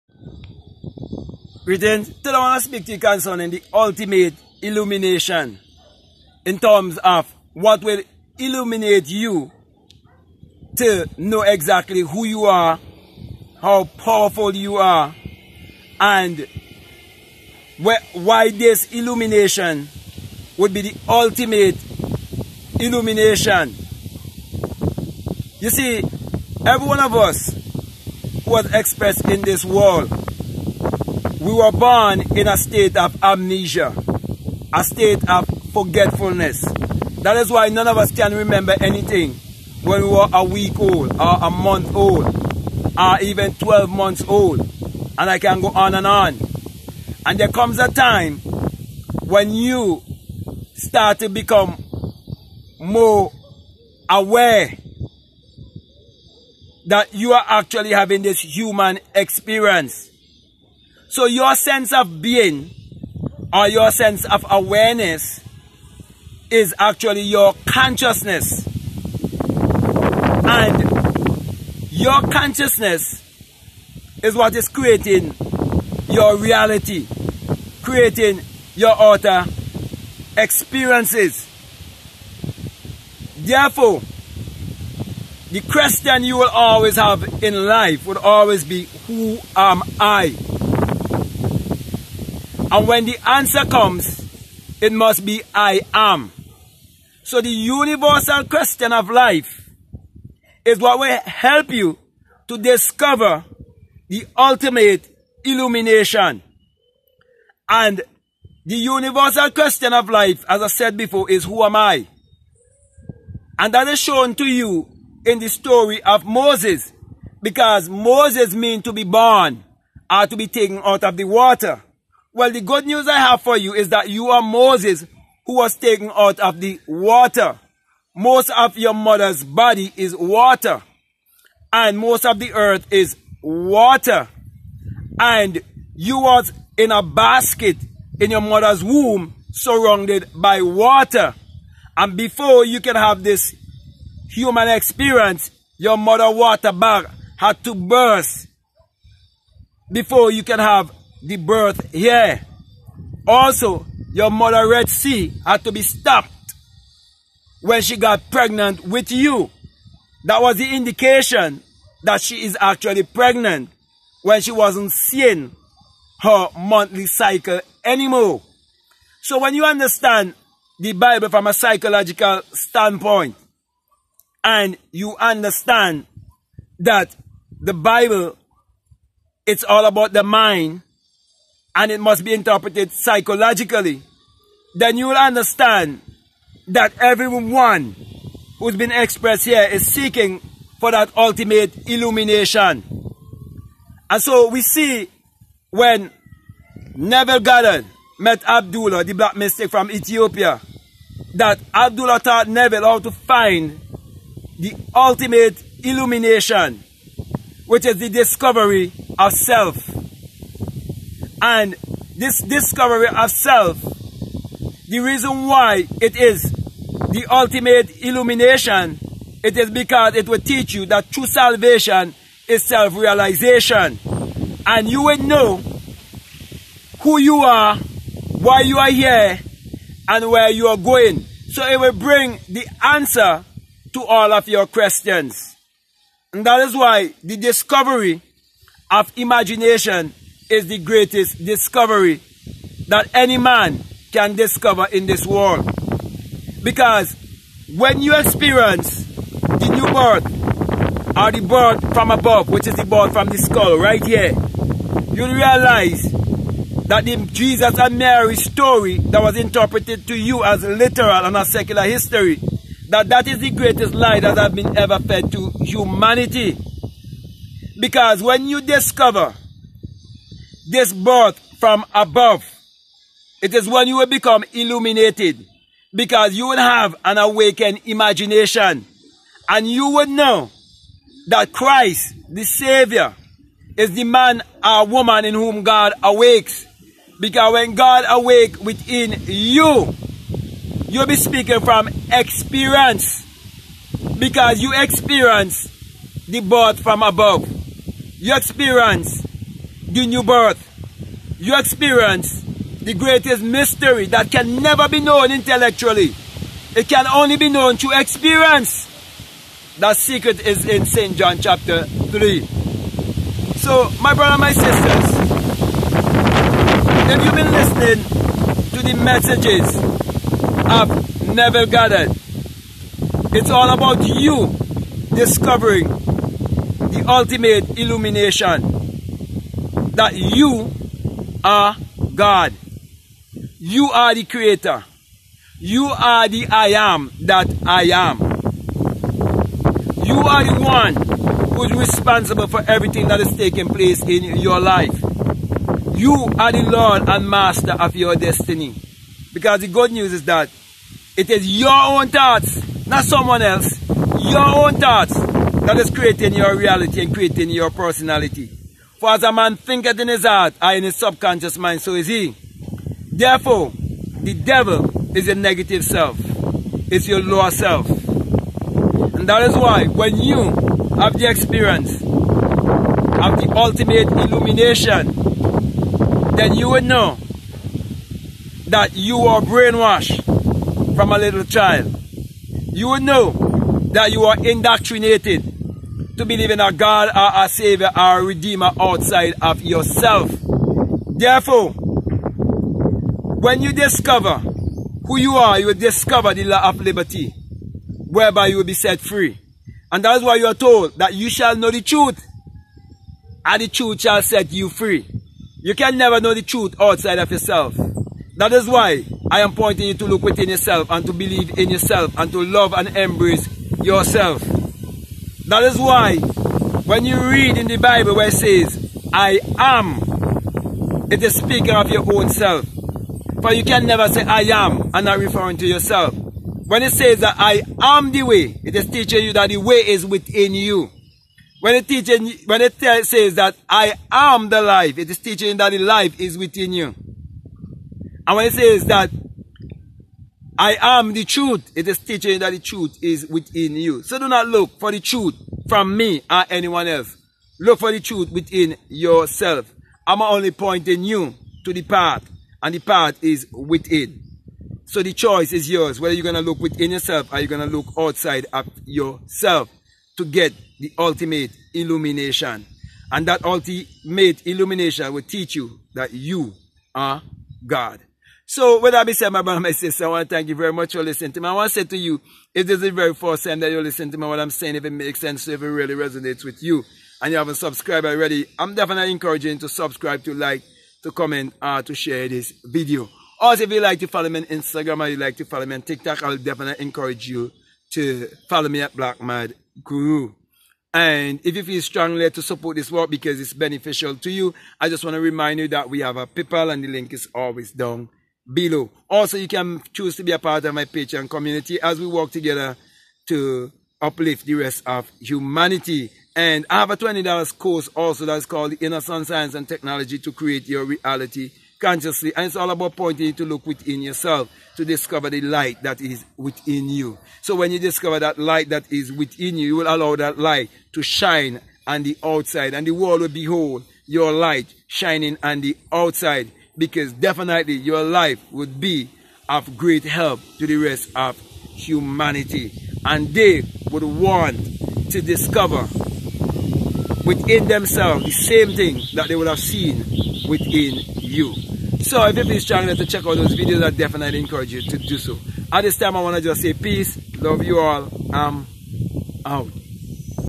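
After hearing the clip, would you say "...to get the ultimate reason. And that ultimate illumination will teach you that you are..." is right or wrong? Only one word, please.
wrong.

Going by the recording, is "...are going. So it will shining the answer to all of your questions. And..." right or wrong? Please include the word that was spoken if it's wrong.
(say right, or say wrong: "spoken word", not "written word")
wrong: "bring", not "shining".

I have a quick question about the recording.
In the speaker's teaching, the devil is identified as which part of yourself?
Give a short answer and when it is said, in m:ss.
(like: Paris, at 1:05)
Your negative self, at 6:05.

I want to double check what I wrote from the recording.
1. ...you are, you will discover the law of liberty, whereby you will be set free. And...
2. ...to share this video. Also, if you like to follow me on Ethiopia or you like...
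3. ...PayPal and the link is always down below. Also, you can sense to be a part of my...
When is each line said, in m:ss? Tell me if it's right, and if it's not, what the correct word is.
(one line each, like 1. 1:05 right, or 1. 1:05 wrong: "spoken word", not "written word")
1. 6:35 right
2. 8:01 wrong: "Instagram", not "Ethiopia"
3. 8:16 wrong: "choose", not "sense".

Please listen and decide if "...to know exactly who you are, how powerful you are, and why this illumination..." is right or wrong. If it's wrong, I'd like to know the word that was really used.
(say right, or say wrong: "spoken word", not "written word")
right.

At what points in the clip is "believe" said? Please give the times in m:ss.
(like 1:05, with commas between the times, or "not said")
6:26, 6:51.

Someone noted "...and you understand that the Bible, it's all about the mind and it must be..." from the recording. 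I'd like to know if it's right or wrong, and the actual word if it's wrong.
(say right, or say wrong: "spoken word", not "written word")
right.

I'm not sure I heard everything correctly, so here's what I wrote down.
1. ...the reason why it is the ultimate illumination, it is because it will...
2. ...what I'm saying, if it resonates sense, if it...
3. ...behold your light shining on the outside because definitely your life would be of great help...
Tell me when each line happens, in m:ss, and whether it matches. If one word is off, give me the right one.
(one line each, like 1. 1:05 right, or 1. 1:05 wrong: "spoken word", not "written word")
1. 3:34 right
2. 7:54 wrong: "makes", not "resonates"
3. 8:43 right.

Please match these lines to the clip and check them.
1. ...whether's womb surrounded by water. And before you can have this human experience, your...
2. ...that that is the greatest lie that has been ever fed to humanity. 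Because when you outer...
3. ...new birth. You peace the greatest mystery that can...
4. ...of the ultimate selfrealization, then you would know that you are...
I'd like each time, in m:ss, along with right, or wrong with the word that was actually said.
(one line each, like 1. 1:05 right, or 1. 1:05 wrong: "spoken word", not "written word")
1. 2:18 wrong: "mother", not "whether"
2. 4:22 wrong: "discover", not "outer"
3. 5:00 wrong: "experience", not "peace"
4. 6:11 wrong: "illumination", not "selfrealization".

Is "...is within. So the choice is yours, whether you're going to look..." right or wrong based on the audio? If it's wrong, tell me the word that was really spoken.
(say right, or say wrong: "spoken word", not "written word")
right.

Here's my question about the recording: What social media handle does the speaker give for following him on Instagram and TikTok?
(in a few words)
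Black Mad Guru.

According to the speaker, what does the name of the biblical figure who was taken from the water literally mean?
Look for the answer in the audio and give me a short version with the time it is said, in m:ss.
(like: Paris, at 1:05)
To be born, at 1:58.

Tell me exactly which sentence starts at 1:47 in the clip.
And the universal question of life, as I said before, is who am I?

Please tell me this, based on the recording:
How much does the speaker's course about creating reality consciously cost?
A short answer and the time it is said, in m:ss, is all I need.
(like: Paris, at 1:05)
$20, at 8:26.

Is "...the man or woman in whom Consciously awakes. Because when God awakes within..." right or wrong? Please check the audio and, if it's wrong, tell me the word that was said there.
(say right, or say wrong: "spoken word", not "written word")
wrong: "God", not "Consciously".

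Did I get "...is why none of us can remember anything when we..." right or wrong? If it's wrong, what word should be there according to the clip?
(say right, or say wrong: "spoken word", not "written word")
right.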